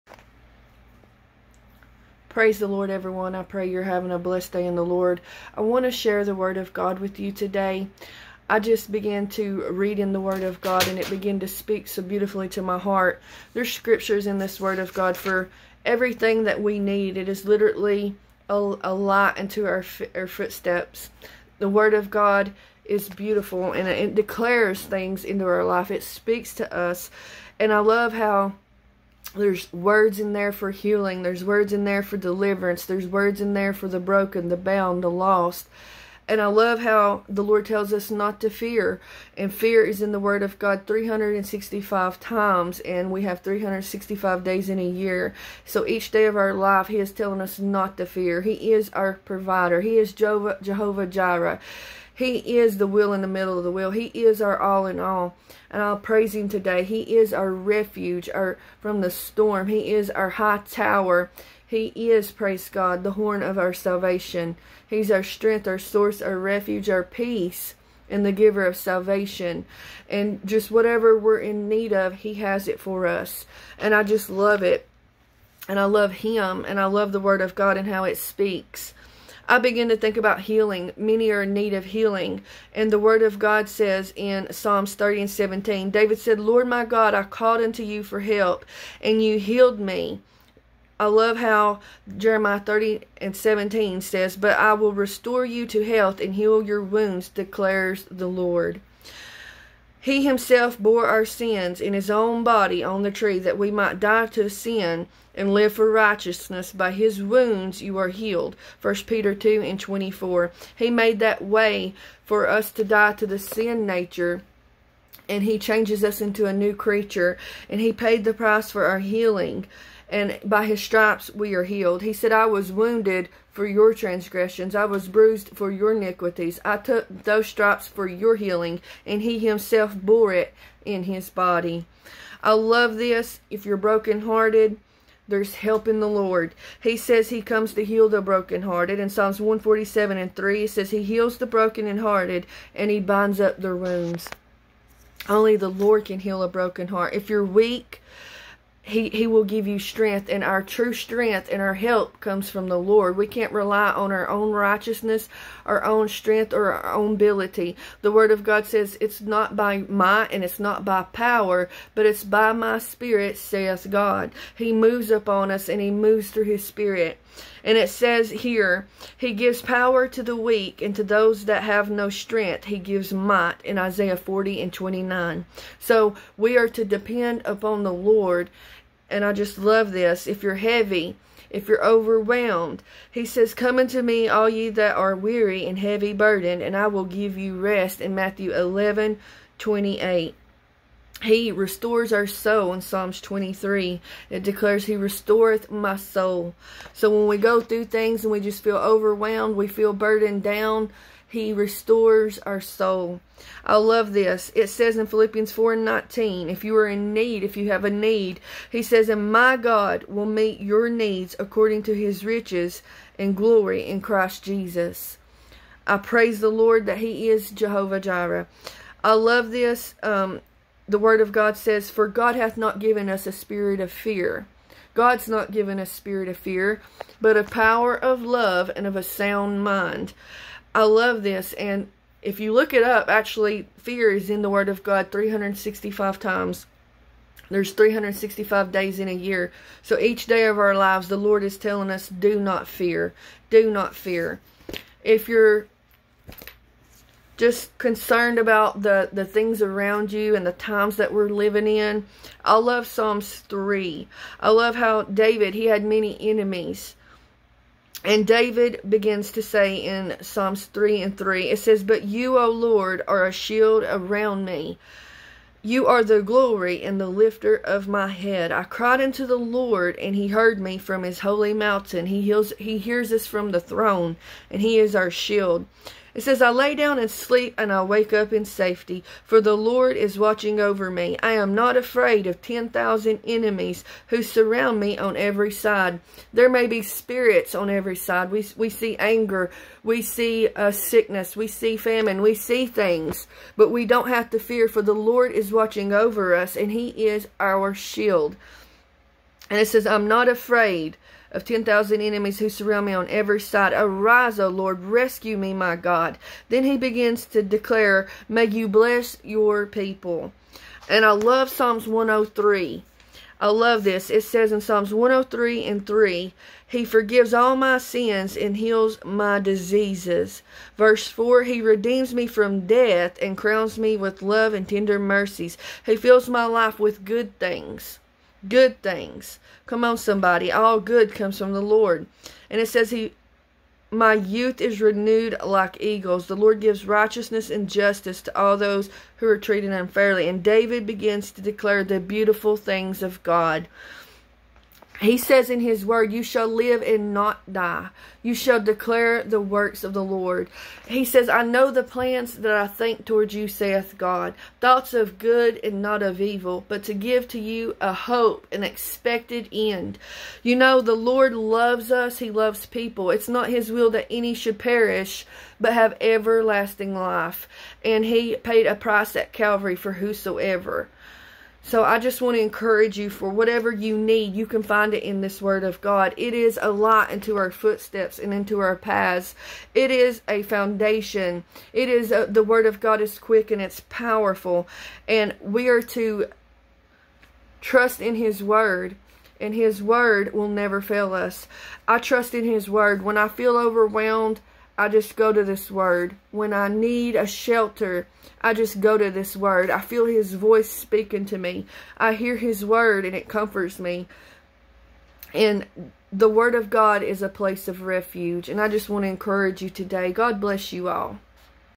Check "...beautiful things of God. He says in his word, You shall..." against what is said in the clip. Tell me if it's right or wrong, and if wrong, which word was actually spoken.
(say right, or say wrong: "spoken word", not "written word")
right.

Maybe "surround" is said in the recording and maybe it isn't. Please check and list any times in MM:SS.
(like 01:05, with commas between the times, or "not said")
04:44, 05:02.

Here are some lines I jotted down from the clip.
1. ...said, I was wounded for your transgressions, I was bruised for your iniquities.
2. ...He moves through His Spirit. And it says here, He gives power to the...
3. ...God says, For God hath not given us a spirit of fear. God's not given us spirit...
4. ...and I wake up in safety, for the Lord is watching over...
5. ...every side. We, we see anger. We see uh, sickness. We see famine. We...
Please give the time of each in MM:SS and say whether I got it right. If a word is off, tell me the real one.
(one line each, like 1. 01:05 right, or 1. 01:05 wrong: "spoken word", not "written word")
1. 02:02 right
2. 02:45 right
3. 03:41 right
4. 04:37 right
5. 04:47 right.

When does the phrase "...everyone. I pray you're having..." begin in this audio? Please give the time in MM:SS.
00:02.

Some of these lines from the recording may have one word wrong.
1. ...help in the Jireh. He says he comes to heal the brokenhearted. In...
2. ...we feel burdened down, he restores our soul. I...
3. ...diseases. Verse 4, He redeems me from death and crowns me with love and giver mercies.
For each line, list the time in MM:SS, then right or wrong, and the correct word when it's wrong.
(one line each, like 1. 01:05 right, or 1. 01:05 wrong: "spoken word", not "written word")
1. 02:15 wrong: "Lord", not "Jireh"
2. 03:19 right
3. 05:19 wrong: "tender", not "giver".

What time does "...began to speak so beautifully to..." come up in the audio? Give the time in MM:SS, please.
00:11.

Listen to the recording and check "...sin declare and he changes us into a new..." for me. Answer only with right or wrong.
wrong.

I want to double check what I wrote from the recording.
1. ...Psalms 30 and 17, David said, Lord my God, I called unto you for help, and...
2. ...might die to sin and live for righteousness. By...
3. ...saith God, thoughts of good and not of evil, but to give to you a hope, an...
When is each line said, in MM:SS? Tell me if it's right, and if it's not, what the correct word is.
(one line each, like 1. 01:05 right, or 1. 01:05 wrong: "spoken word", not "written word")
1. 01:24 right
2. 01:43 right
3. 05:53 right.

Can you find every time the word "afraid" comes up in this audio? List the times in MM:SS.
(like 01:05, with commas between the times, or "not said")
04:41, 05:00.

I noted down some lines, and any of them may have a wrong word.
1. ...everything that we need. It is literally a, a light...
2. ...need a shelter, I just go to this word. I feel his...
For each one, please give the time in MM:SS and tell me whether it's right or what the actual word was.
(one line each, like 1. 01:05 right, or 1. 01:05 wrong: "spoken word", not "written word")
1. 00:15 right
2. 06:36 right.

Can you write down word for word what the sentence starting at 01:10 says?
And just whatever we're in need of, he has it for us.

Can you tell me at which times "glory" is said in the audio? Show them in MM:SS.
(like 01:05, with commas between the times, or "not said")
03:33, 04:26.